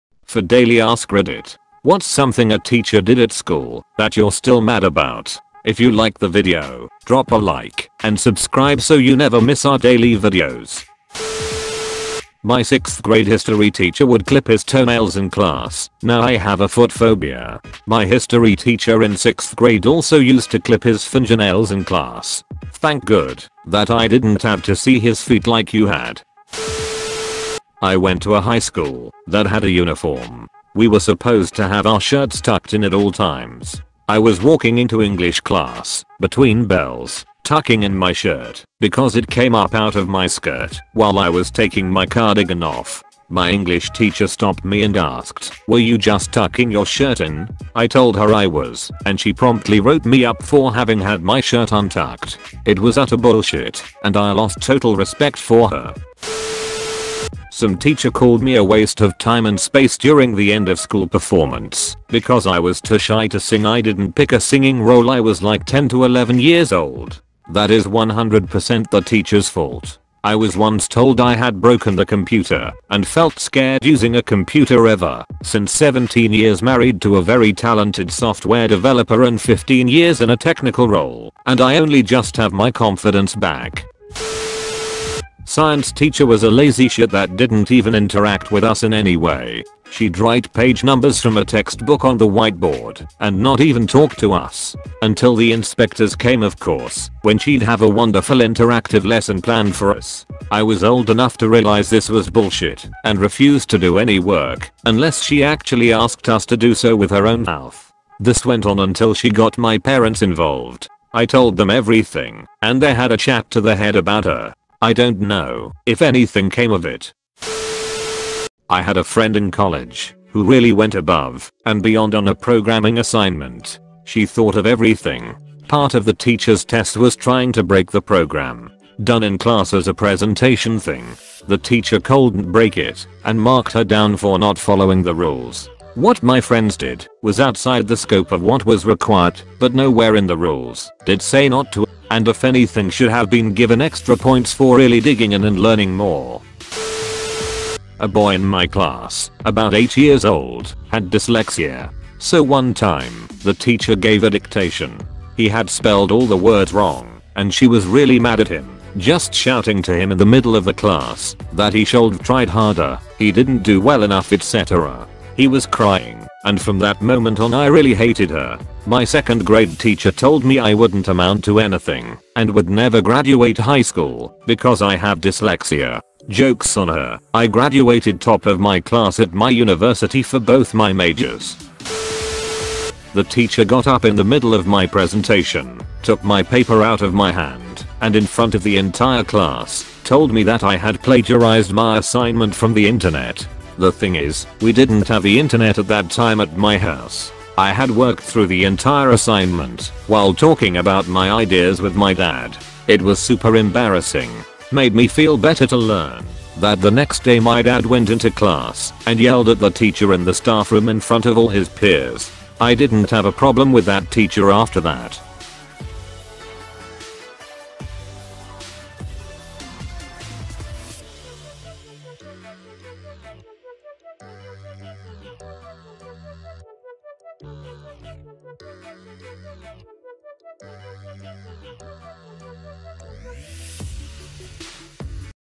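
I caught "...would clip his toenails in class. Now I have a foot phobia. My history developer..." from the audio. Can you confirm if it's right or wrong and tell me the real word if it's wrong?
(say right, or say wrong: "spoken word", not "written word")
wrong: "teacher", not "developer".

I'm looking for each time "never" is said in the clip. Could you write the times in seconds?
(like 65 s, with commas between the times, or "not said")
9 s, 172 s.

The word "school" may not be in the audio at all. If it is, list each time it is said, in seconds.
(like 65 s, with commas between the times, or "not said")
3 s, 28 s, 60 s, 173 s.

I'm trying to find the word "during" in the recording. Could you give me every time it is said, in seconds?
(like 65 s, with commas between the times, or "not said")
59 s.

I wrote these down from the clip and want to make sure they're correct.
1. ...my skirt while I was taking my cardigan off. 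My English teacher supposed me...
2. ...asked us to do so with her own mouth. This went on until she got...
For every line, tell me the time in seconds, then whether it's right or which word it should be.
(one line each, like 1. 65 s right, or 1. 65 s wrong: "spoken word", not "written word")
1. 40 s wrong: "stopped", not "supposed"
2. 105 s right.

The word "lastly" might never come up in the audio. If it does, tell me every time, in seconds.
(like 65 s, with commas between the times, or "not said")
not said.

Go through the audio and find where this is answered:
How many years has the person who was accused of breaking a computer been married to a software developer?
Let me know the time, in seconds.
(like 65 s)
75 s.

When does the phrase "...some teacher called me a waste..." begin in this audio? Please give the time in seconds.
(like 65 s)
57 s.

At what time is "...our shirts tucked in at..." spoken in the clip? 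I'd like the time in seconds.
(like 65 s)
31 s.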